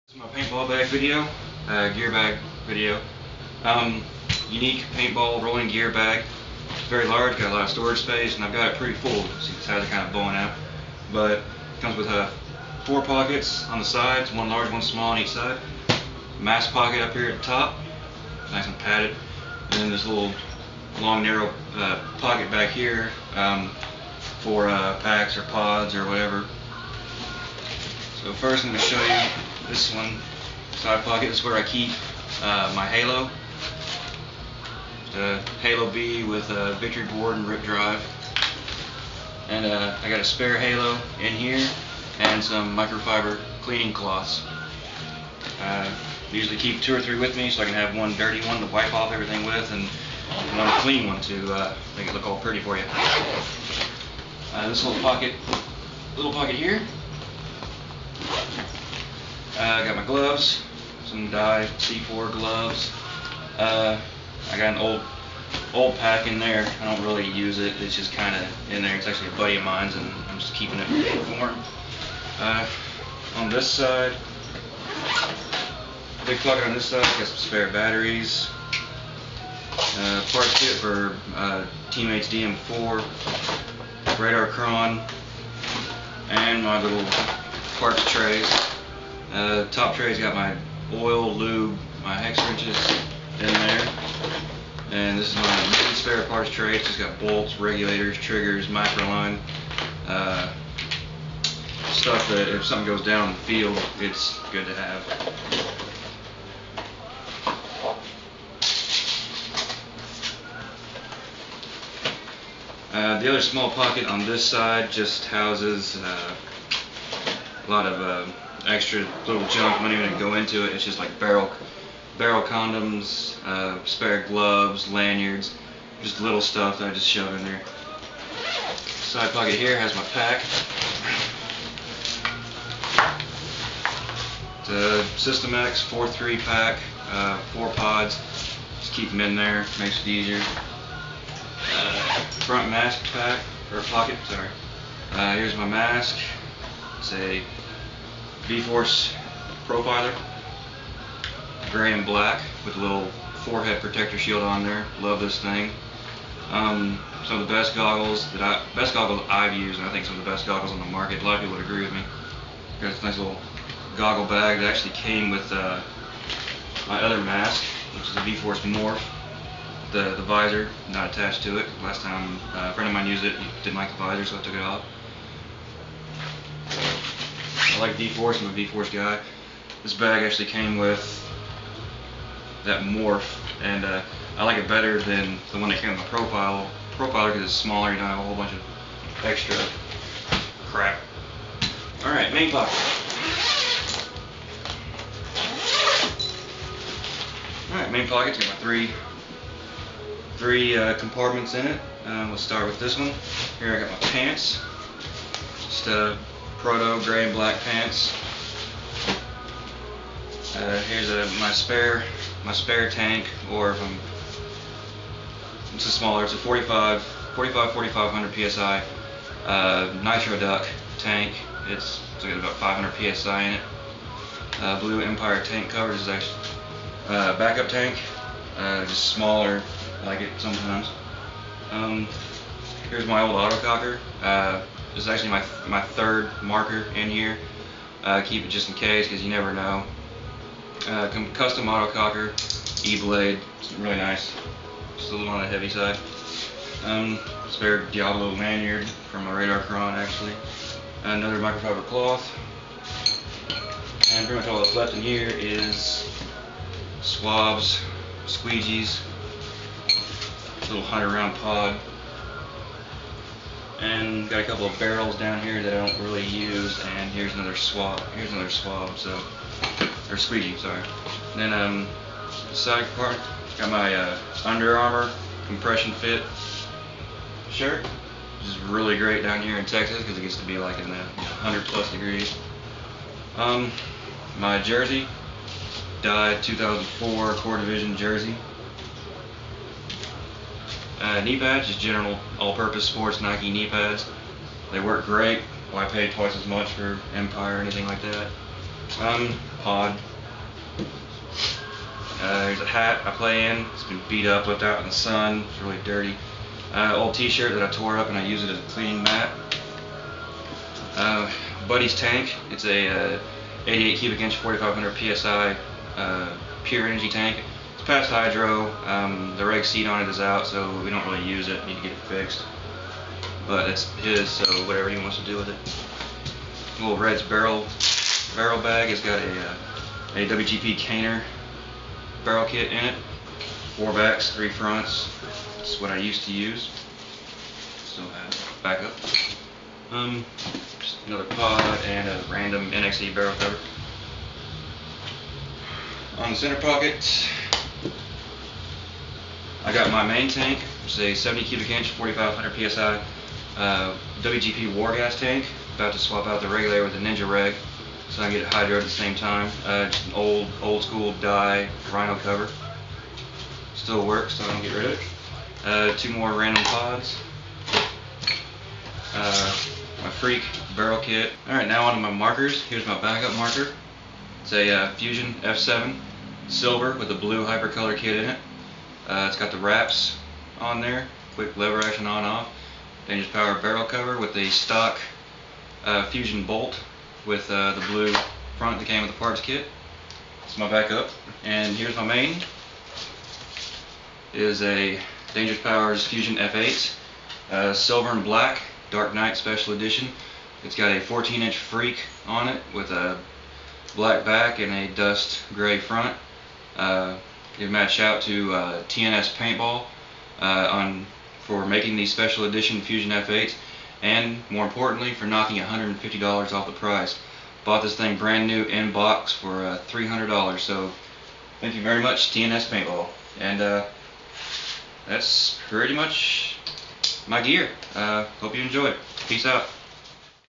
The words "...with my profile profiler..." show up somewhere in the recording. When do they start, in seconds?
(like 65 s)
185 s.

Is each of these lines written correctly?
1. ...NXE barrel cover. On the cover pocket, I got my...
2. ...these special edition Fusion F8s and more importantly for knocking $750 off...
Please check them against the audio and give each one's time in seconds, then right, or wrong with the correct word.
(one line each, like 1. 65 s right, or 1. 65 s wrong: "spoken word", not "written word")
1. 342 s wrong: "center", not "cover"
2. 411 s wrong: "150", not "750".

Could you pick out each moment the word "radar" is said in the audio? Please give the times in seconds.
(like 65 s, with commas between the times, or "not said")
84 s, 249 s.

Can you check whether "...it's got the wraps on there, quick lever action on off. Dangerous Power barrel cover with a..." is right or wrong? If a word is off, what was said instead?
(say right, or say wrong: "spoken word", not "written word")
right.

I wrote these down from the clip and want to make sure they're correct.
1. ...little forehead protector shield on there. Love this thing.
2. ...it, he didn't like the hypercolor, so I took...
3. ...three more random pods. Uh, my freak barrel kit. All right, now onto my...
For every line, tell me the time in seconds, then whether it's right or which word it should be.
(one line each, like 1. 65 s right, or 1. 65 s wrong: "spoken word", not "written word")
1. 152 s right
2. 173 s wrong: "visor", not "hypercolor"
3. 365 s wrong: "two", not "three".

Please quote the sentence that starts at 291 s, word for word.
Uh, knee pads, just general all-purpose sports Nike knee pads.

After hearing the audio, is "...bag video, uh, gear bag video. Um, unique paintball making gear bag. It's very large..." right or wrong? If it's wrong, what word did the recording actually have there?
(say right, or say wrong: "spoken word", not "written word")
wrong: "rolling", not "making".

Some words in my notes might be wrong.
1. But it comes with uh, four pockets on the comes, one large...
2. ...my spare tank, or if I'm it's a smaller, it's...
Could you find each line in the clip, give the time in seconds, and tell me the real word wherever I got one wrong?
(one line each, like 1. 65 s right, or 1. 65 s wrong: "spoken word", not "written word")
1. 11 s wrong: "sides", not "comes"
2. 212 s right.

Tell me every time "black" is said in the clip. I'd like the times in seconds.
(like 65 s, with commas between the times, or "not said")
152 s, 207 s, 398 s, 403 s.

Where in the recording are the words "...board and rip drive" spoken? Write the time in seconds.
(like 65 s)
37 s.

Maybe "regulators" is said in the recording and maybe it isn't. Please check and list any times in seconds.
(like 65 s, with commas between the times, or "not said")
97 s, 356 s.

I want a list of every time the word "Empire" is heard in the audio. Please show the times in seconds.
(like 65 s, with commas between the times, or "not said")
225 s, 297 s.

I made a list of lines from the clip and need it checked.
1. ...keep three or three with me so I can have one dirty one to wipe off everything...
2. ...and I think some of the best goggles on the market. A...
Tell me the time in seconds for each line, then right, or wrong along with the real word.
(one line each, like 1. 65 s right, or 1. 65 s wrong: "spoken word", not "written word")
1. 46 s wrong: "two", not "three"
2. 159 s right.